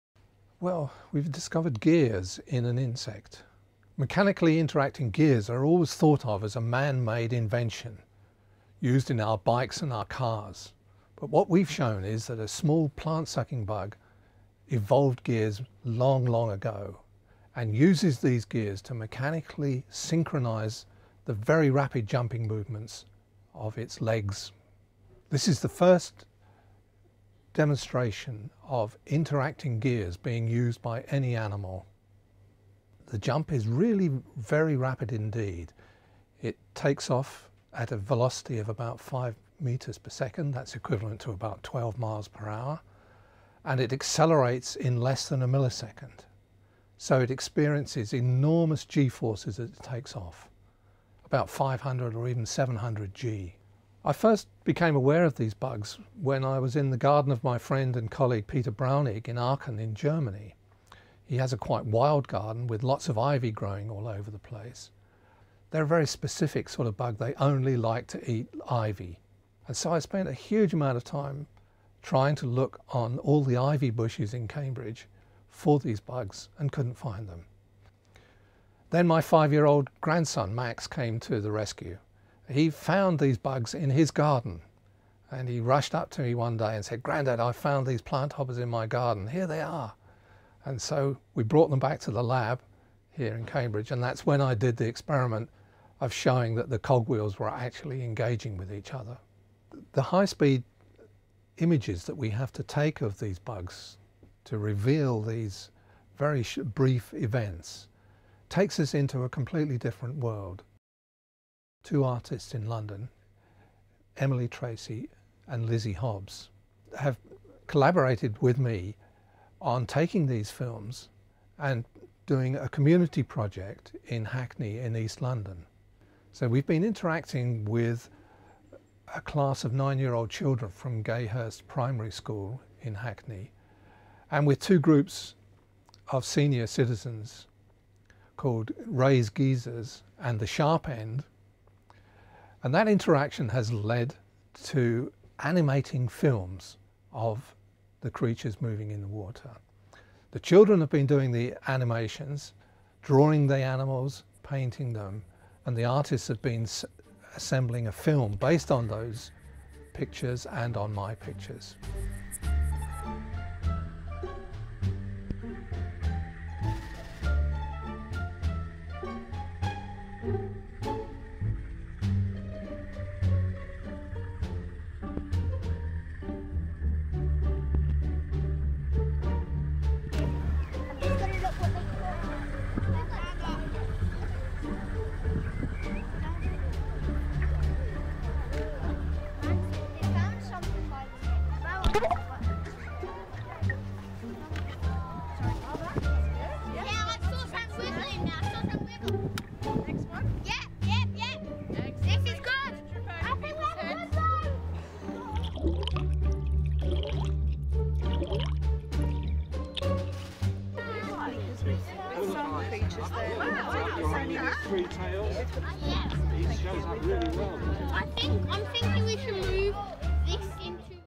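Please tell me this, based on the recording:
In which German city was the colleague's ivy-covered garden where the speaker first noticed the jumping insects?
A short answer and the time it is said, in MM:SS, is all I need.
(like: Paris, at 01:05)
Aachen, at 00:59.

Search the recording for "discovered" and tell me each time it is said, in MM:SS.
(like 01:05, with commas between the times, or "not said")
00:01.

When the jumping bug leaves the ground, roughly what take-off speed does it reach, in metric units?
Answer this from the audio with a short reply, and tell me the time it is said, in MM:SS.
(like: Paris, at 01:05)
5 meters per second, at 00:38.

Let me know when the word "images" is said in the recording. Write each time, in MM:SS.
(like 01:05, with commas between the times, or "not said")
01:41.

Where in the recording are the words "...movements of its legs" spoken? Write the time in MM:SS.
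00:22.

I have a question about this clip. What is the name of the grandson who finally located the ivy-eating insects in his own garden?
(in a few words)
Max.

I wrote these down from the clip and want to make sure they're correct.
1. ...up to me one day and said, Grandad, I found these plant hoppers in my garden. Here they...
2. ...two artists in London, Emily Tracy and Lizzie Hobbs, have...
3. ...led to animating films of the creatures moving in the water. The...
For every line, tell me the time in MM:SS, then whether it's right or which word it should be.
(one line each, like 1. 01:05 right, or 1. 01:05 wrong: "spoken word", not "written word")
1. 01:25 right
2. 01:51 right
3. 02:23 right.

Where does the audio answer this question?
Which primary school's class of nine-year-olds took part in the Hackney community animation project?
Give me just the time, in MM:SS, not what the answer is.
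02:11.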